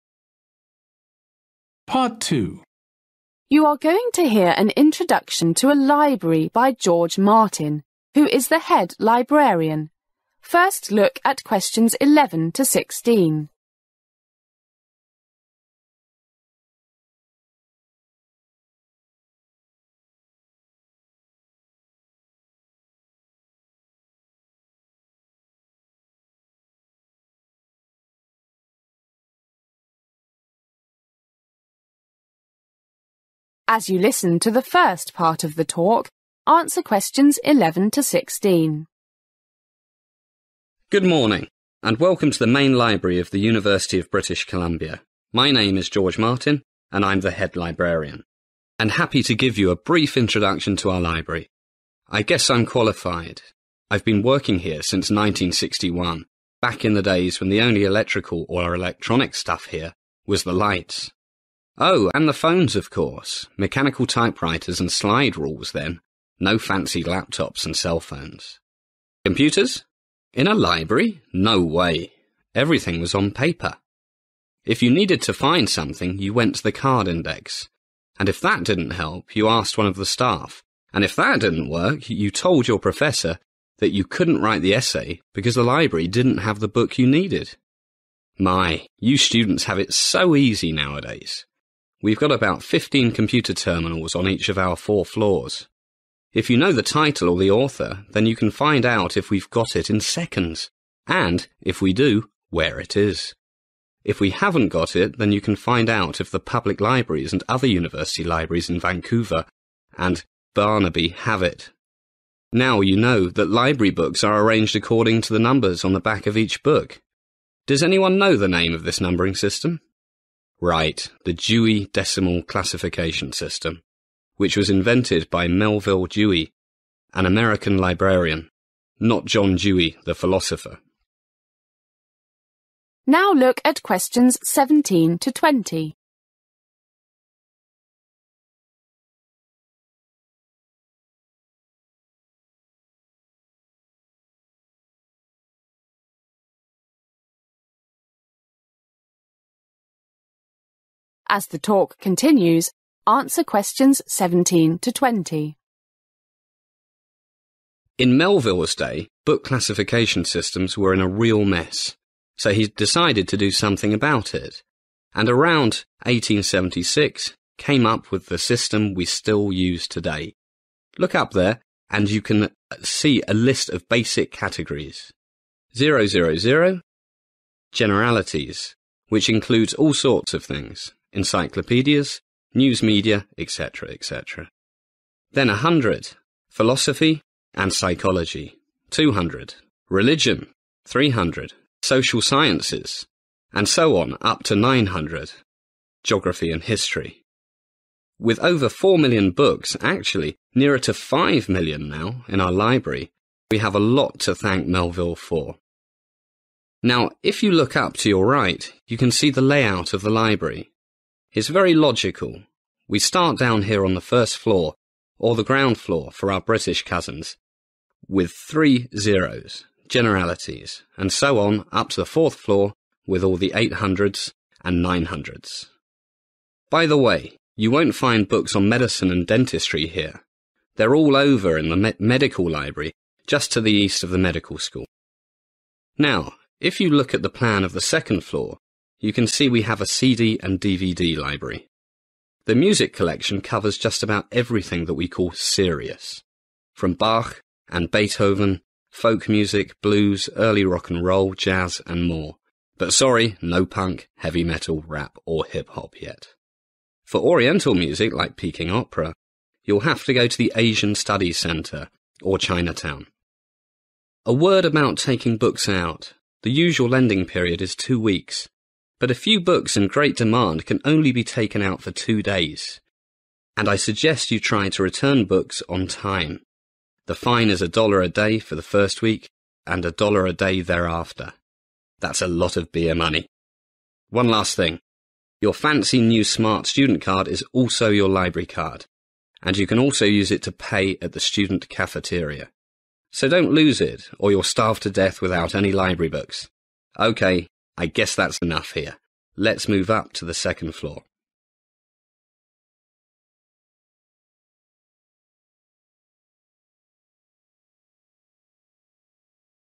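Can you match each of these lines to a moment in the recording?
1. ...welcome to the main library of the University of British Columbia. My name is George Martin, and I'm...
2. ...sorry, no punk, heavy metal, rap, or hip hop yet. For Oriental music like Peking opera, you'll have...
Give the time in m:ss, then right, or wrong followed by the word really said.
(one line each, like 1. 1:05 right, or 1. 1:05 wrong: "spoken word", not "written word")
1. 0:41 right
2. 4:12 right.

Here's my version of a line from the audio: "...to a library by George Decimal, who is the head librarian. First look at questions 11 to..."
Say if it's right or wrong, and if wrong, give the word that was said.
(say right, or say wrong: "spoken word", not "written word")
wrong: "Martin", not "Decimal".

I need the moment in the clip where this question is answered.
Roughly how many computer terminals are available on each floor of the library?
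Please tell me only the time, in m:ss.
1:32.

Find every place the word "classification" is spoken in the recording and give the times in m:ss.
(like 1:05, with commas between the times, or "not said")
2:02, 2:39.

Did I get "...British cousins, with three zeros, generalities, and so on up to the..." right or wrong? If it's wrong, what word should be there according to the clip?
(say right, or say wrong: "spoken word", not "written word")
right.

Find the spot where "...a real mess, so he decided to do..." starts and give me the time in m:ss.
2:40.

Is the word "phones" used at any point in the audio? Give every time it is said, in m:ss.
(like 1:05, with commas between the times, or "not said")
1:02, 1:07.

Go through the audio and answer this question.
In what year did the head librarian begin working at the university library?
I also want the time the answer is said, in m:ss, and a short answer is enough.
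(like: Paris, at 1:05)
1961, at 0:55.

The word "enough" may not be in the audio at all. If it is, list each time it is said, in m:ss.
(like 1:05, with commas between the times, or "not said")
4:58.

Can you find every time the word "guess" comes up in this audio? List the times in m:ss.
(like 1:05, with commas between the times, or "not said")
0:52, 4:57.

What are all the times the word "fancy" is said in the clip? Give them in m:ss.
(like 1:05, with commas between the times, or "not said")
1:06, 4:45.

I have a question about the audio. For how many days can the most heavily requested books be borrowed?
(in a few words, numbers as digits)
2 days.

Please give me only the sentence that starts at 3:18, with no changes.
With over 4 million books, actually nearer to 5 million now, in our library, we have a lot to thank Melville for.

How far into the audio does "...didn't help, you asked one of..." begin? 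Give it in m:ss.
1:18.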